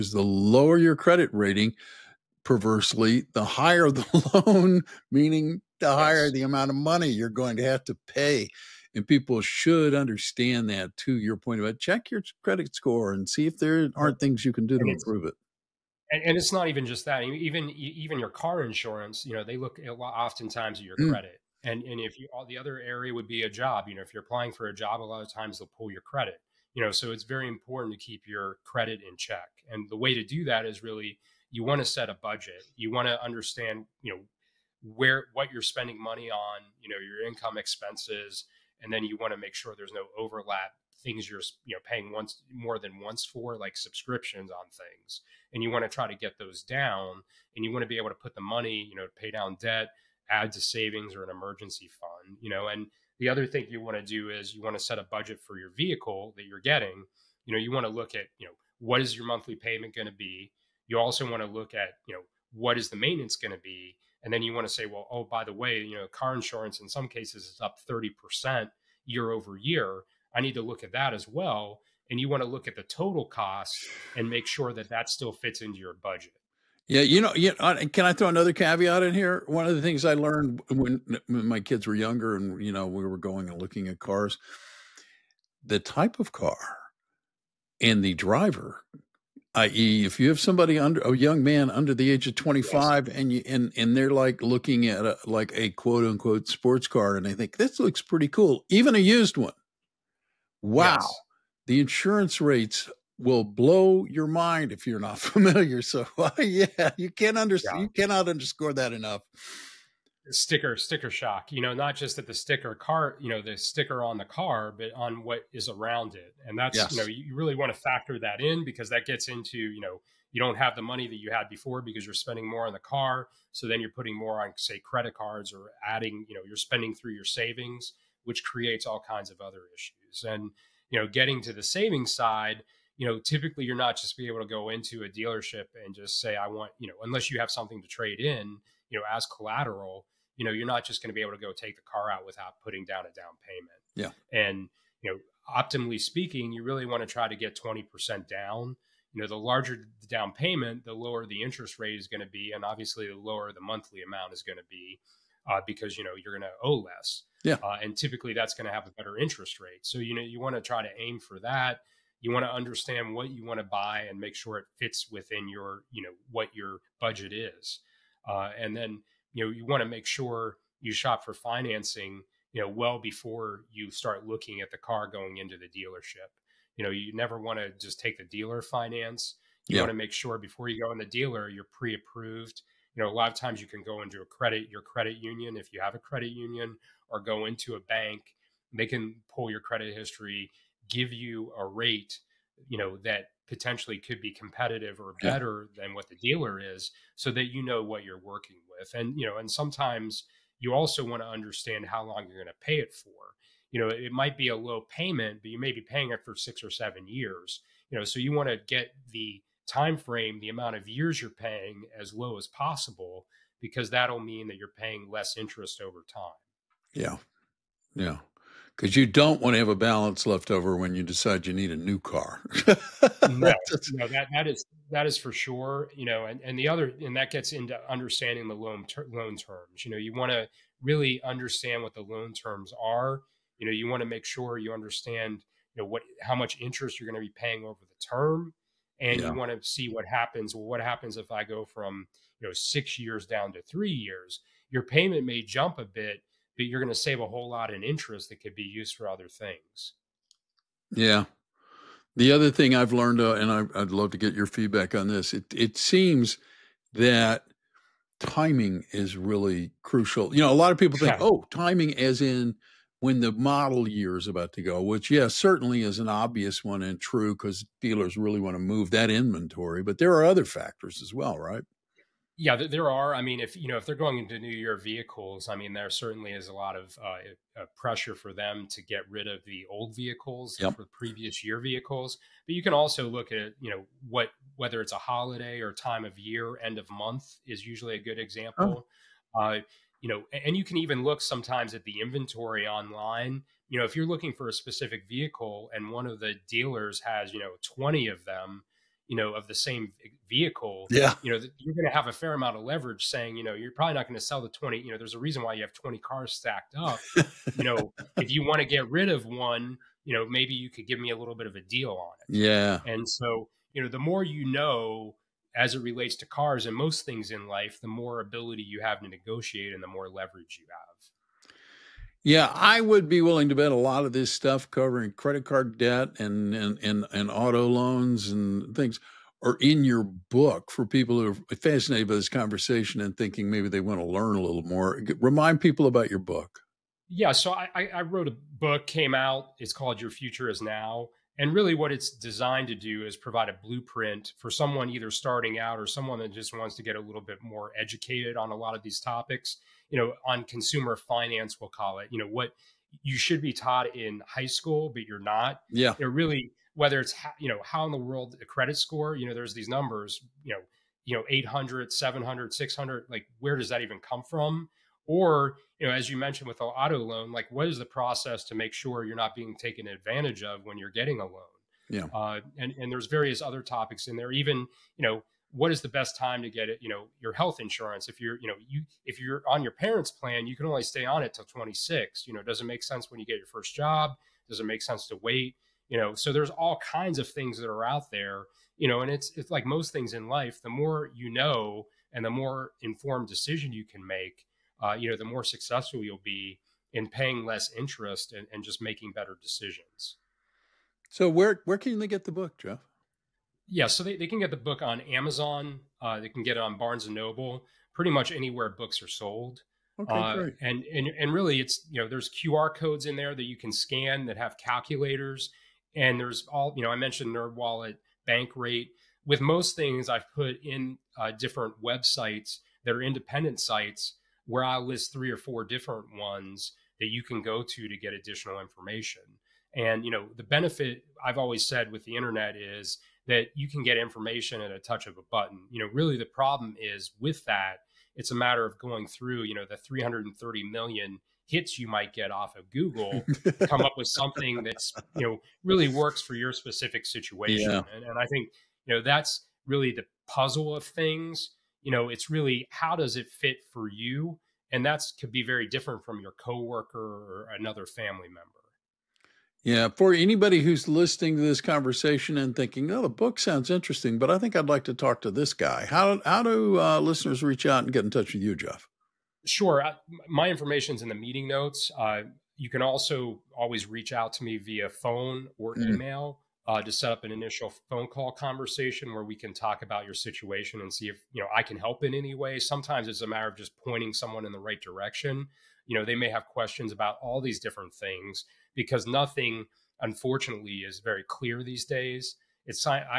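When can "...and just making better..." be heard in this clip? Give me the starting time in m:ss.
6:38.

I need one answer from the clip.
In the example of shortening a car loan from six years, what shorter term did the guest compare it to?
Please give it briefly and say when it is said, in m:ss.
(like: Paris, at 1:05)
three years, at 4:03.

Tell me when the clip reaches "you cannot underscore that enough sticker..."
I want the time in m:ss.
1:47.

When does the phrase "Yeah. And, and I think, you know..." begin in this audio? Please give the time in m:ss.
7:27.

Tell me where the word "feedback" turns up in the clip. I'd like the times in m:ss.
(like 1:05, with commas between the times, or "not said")
4:14.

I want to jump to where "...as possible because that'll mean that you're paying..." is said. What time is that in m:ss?
3:32.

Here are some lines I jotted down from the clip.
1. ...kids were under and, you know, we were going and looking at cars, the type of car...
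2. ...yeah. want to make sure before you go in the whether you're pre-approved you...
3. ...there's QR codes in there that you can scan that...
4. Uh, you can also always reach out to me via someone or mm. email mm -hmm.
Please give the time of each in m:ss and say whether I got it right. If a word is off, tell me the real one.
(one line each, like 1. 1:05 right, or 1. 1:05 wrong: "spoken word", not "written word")
1. 1:21 wrong: "younger", not "under"
2. 2:59 wrong: "dealer", not "whether"
3. 6:52 right
4. 7:51 wrong: "phone", not "someone".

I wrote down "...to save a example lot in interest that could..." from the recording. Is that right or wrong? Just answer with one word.
wrong.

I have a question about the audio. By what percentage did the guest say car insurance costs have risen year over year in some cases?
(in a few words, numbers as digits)
30%.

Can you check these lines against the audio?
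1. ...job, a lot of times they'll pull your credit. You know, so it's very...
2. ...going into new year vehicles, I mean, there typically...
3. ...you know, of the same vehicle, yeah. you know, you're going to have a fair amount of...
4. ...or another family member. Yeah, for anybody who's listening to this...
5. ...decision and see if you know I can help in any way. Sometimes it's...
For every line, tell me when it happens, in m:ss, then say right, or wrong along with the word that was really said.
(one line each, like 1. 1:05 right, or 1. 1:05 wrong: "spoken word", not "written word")
1. 0:24 right
2. 4:33 wrong: "certainly", not "typically"
3. 4:59 right
4. 7:36 right
5. 8:00 wrong: "situation", not "decision".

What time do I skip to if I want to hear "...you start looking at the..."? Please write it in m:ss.
2:53.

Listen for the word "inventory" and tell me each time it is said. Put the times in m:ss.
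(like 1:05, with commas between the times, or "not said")
4:29, 4:52.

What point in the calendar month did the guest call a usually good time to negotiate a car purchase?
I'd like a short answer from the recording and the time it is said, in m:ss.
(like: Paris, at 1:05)
end of month, at 4:46.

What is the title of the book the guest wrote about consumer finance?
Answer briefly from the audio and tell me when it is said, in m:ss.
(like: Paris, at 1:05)
Your Future Is Now, at 5:40.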